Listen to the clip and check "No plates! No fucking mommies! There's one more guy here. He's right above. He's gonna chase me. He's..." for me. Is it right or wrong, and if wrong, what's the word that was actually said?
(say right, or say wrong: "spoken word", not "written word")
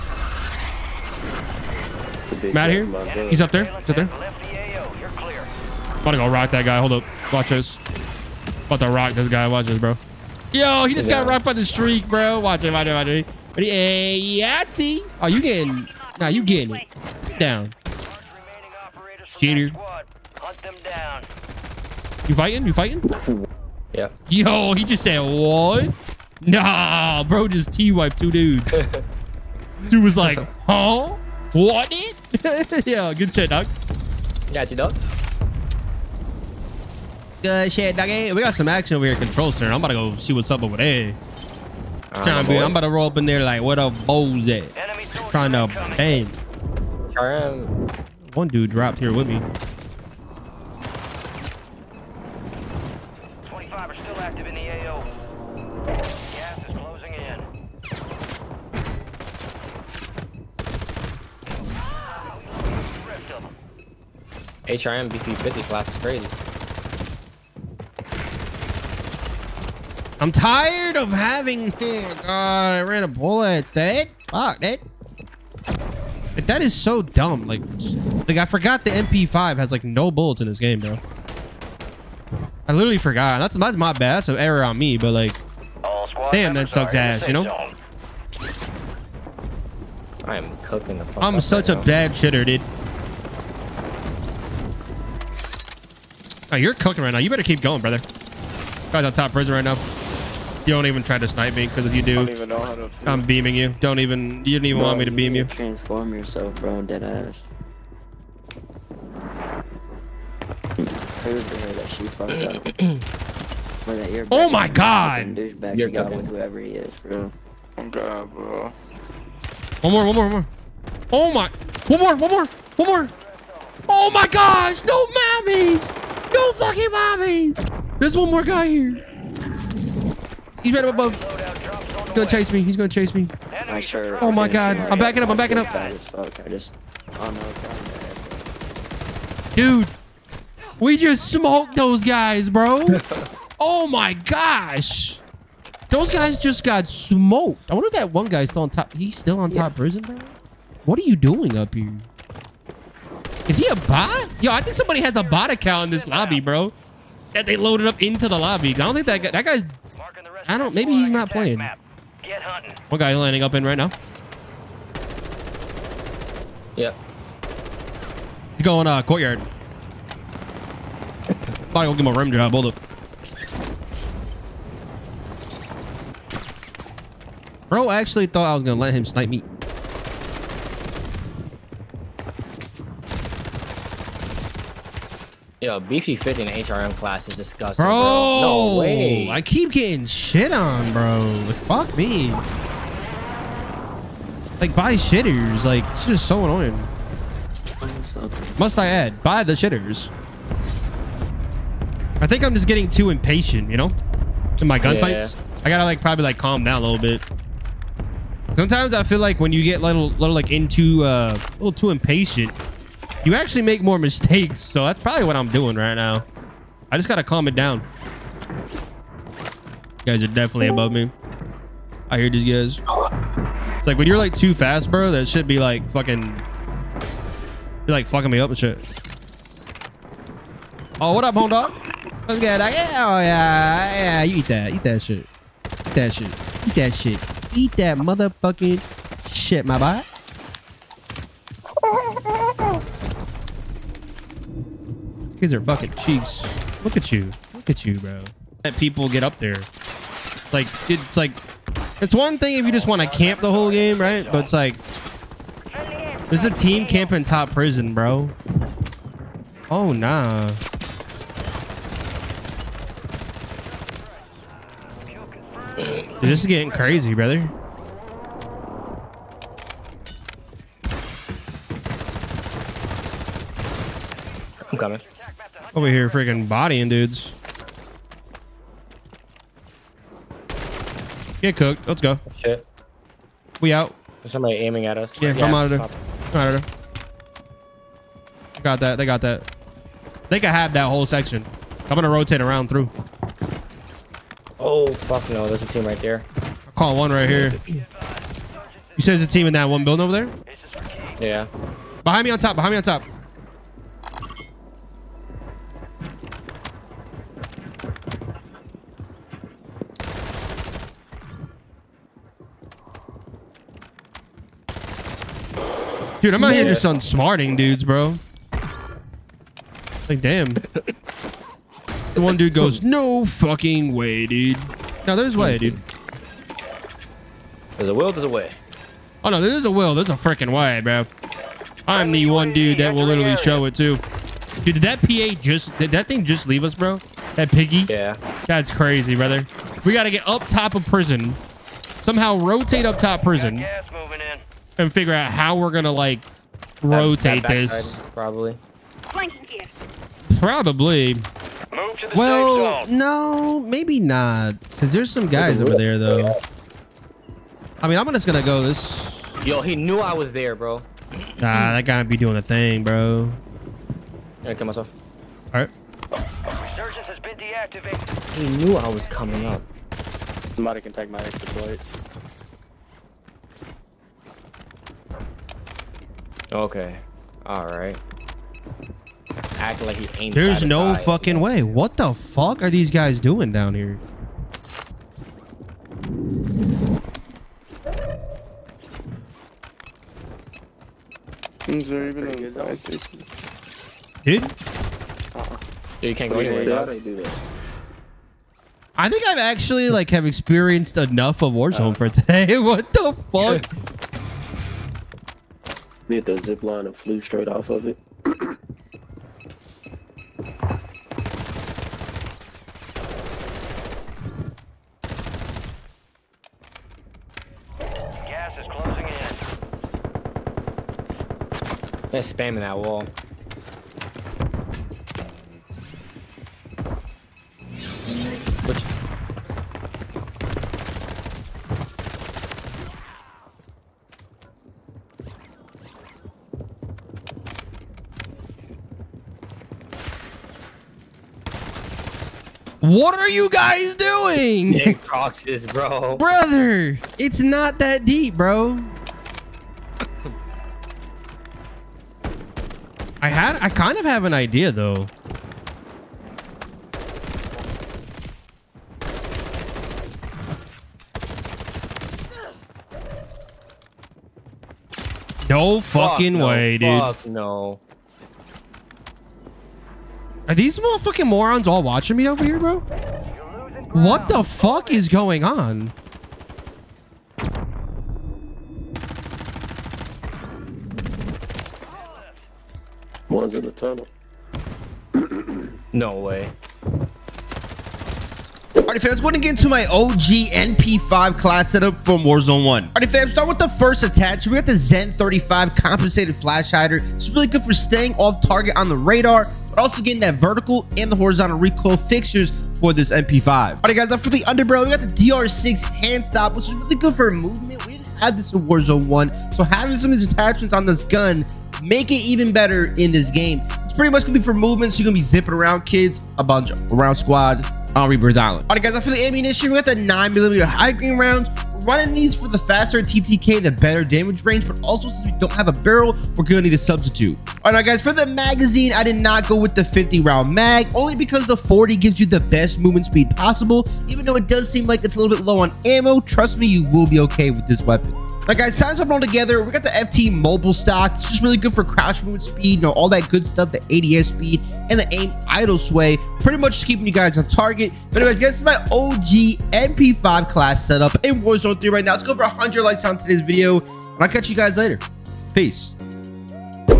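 wrong: "mommies", not "plates".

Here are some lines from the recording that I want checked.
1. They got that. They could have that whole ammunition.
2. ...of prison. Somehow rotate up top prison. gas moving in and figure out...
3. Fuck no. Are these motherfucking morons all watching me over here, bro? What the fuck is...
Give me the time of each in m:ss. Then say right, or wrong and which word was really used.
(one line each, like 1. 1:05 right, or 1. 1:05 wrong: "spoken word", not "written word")
1. 4:48 wrong: "section", not "ammunition"
2. 5:40 right
3. 7:46 right.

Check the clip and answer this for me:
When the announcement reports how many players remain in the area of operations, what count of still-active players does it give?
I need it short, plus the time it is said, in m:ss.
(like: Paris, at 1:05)
25, at 0:53.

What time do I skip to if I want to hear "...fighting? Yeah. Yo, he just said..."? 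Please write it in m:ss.
0:22.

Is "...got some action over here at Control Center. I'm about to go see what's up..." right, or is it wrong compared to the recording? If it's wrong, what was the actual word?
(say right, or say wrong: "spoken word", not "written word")
right.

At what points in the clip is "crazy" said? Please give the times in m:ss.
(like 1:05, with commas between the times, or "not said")
1:06, 4:26, 5:38.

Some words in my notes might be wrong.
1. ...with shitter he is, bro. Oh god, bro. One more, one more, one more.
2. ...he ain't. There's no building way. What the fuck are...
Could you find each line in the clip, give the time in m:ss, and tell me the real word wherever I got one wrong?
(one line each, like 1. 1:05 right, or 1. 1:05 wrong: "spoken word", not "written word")
1. 1:56 wrong: "whoever", not "shitter"
2. 6:19 wrong: "fucking", not "building".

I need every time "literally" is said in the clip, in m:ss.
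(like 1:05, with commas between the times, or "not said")
1:22, 5:33.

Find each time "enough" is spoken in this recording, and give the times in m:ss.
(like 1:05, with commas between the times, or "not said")
6:40.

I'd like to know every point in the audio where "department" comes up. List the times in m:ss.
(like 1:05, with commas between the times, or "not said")
not said.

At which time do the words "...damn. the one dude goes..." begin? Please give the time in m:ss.
5:20.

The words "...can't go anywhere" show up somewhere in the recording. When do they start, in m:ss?
6:36.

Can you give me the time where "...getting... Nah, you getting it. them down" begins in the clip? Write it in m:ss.
0:15.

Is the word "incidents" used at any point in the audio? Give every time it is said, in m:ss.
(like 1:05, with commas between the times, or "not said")
not said.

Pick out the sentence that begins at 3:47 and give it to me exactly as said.
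You're like fucking me up and shit.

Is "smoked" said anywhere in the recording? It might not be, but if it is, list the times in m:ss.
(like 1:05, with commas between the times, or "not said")
2:21, 2:26.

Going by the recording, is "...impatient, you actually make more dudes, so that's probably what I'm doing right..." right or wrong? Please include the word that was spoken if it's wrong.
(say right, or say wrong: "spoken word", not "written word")
wrong: "mistakes", not "dudes".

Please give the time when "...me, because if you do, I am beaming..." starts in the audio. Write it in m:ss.
1:41.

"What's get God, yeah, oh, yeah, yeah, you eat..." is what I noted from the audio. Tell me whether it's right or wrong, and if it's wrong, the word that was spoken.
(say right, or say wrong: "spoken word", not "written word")
wrong: "Like", not "God".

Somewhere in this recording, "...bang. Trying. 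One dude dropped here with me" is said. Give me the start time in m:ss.
0:45.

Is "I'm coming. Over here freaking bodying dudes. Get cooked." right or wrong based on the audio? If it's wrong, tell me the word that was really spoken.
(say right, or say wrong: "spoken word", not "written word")
right.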